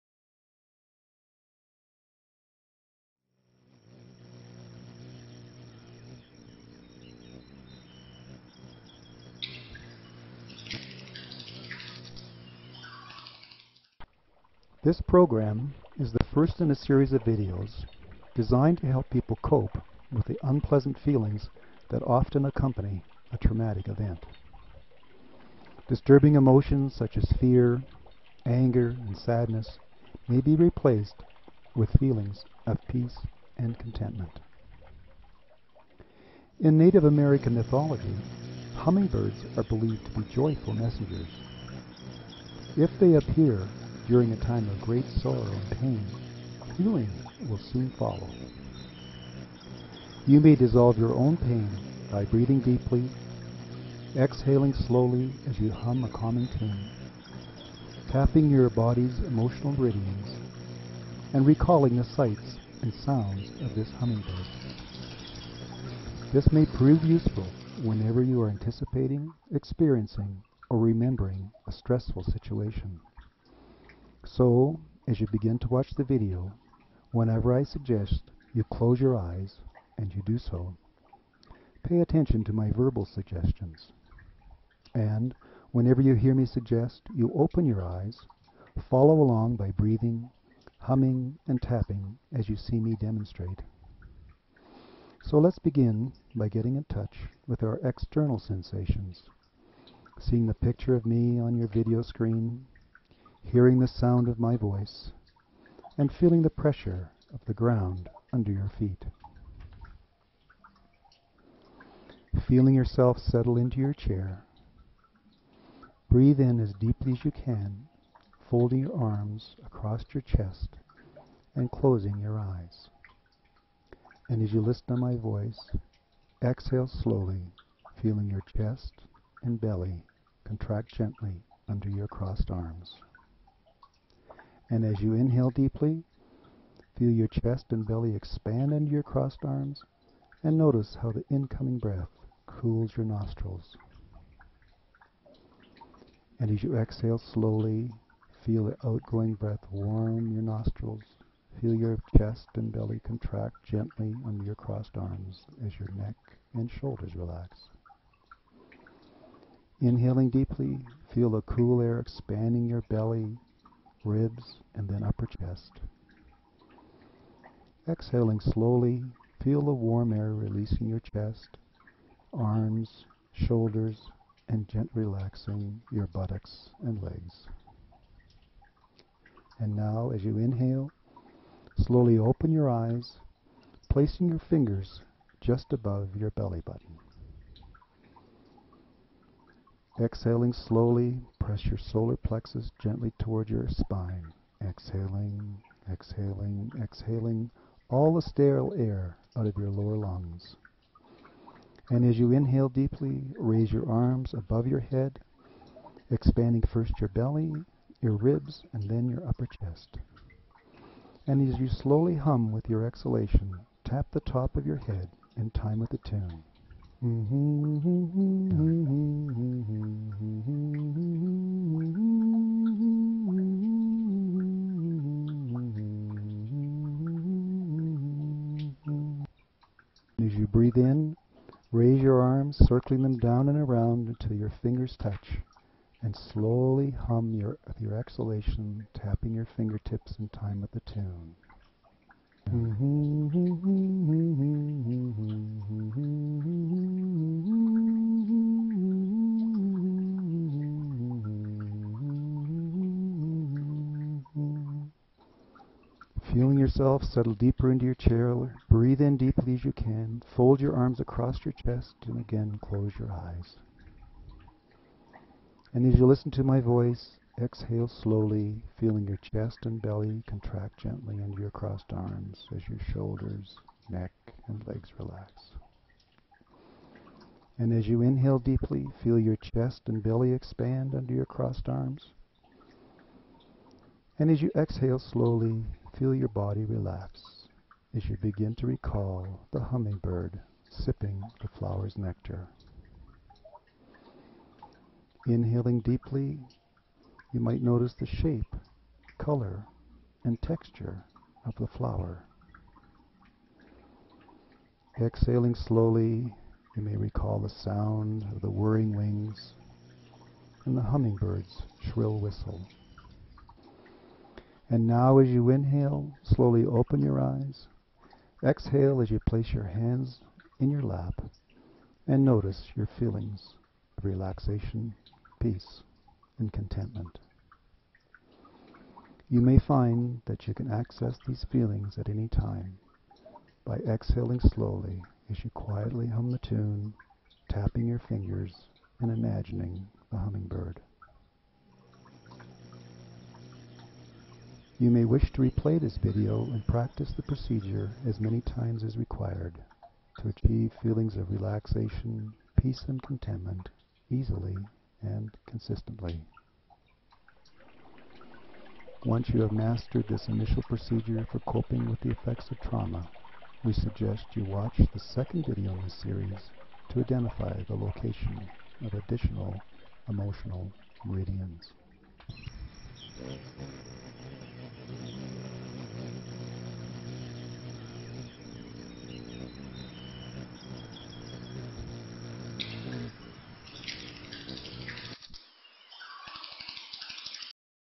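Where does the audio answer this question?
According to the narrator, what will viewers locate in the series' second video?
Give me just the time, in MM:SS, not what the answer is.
06:08.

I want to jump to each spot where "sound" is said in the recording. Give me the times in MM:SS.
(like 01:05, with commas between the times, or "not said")
01:02, 01:43, 05:07.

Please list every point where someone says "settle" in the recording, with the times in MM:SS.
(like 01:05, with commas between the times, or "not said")
01:53, 04:17.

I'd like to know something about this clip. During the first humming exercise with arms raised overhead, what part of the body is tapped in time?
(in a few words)
top of your head.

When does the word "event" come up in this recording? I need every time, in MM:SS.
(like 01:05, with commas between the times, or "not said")
00:23.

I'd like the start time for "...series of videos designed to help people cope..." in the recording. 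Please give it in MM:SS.
00:16.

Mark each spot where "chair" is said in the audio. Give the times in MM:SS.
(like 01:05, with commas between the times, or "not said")
01:53, 04:17.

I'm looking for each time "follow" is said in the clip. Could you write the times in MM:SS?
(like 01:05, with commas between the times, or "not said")
00:47, 01:28.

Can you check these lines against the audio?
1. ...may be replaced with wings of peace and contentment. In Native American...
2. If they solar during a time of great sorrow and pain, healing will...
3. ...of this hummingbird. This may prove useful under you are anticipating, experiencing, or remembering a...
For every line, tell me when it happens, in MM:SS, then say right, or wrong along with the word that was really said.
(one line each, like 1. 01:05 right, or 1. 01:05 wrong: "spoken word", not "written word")
1. 00:30 wrong: "feelings", not "wings"
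2. 00:42 wrong: "appear", not "solar"
3. 01:03 wrong: "whenever", not "under".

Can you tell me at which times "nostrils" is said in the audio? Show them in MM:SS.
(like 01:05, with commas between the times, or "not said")
02:23, 02:30.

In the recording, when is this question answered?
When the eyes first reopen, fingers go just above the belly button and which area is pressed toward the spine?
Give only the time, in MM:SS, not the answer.
03:11.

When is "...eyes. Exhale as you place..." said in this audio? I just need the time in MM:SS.
05:17.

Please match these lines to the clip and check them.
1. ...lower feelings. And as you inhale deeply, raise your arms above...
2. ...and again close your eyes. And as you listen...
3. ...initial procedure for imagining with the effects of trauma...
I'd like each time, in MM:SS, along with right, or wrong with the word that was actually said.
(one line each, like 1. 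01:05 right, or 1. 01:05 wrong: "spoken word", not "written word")
1. 03:19 wrong: "lungs", not "feelings"
2. 04:22 right
3. 06:00 wrong: "coping", not "imagining".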